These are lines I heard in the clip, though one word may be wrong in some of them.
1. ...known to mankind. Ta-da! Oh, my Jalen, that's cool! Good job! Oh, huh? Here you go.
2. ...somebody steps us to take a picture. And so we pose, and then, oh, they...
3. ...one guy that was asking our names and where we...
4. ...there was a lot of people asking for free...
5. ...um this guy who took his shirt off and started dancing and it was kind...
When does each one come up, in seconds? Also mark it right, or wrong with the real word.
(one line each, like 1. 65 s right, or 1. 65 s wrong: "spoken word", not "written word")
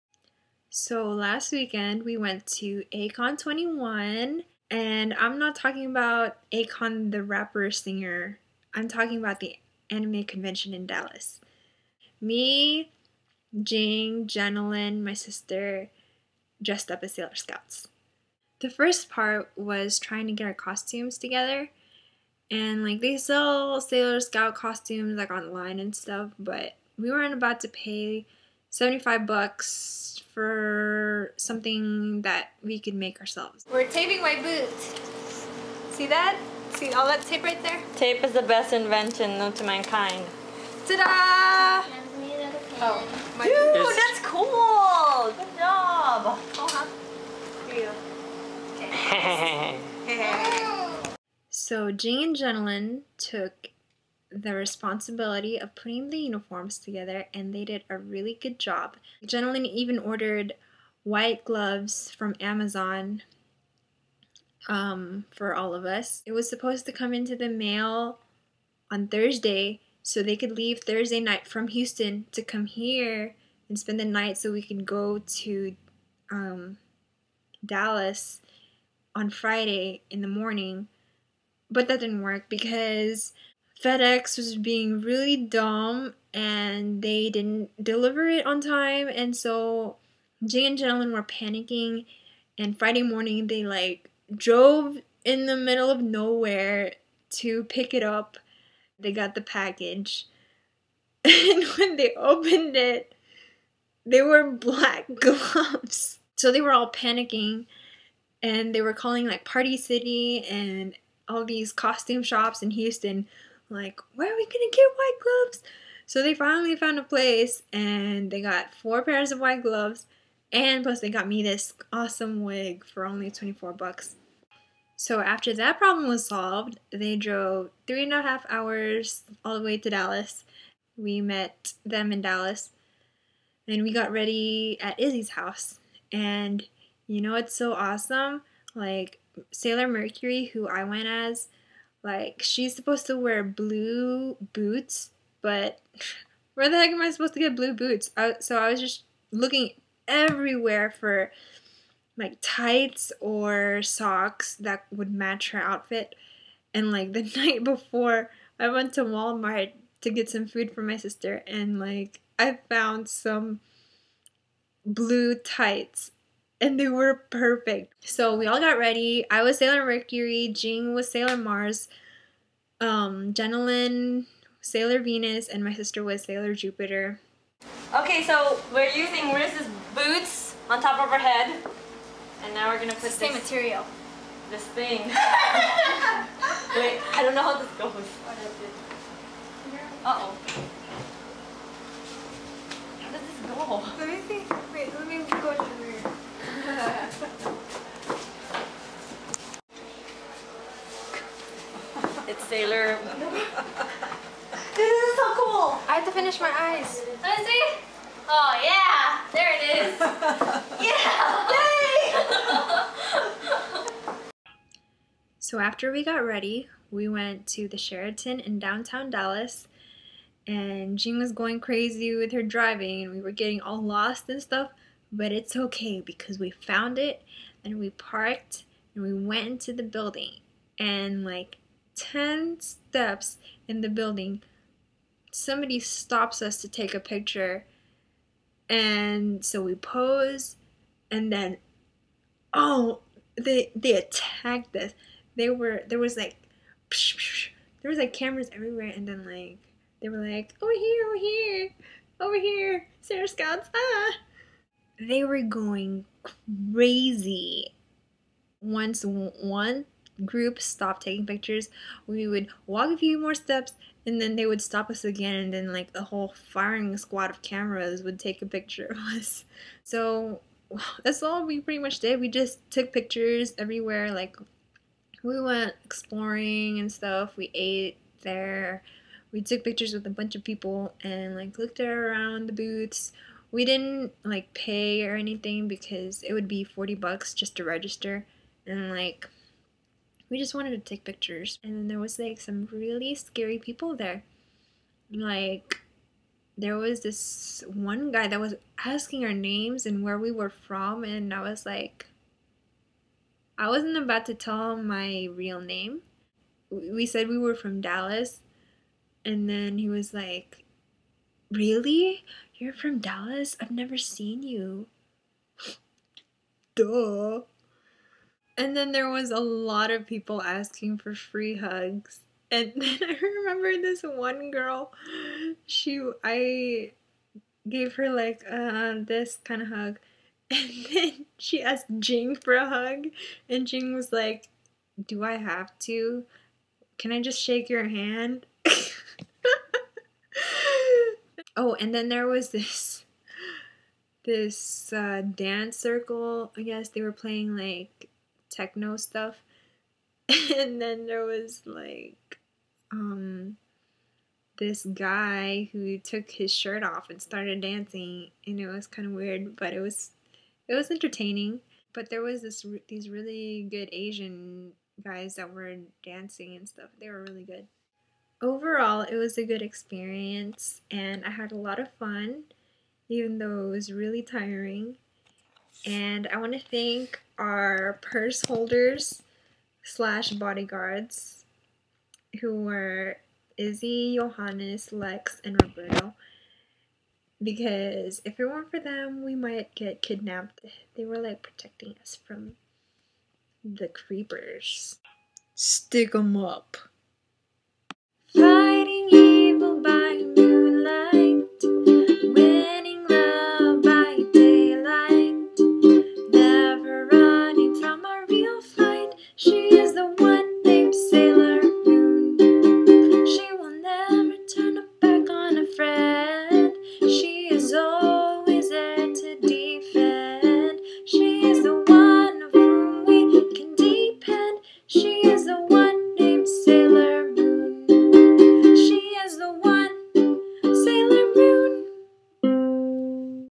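1. 39 s wrong: "Dude", not "Jalen"
2. 235 s wrong: "stops", not "steps"
3. 297 s right
4. 318 s right
5. 352 s right.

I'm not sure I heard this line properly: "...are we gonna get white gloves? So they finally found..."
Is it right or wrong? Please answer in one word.
right.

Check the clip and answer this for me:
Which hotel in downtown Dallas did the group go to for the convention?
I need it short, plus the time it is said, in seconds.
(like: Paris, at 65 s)
Sheraton, at 217 s.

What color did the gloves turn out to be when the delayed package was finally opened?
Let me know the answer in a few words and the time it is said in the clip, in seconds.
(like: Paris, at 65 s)
Black, at 104 s.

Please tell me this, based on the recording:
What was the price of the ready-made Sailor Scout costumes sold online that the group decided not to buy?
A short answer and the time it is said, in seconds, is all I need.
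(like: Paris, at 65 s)
$75, at 28 s.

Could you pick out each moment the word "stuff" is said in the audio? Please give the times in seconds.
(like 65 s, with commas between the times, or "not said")
25 s, 224 s, 276 s, 348 s, 366 s.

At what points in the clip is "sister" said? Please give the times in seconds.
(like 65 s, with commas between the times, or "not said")
15 s, 160 s, 175 s.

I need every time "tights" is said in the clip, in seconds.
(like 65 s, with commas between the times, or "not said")
152 s, 165 s.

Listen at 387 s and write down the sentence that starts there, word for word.
Because if it weren't for them, we might get kidnapped.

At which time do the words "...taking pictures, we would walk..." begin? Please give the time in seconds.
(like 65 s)
261 s.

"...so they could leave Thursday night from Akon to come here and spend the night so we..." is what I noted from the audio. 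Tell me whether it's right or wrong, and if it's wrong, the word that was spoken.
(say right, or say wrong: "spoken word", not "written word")
wrong: "Houston", not "Akon".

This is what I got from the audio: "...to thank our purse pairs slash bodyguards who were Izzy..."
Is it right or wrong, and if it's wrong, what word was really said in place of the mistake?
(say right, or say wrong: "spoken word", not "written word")
wrong: "holders", not "pairs".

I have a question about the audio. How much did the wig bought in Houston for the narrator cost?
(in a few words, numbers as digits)
$24.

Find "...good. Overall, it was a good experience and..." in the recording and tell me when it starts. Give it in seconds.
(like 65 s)
367 s.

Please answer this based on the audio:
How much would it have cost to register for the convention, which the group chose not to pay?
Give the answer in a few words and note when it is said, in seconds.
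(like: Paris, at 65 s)
$40, at 286 s.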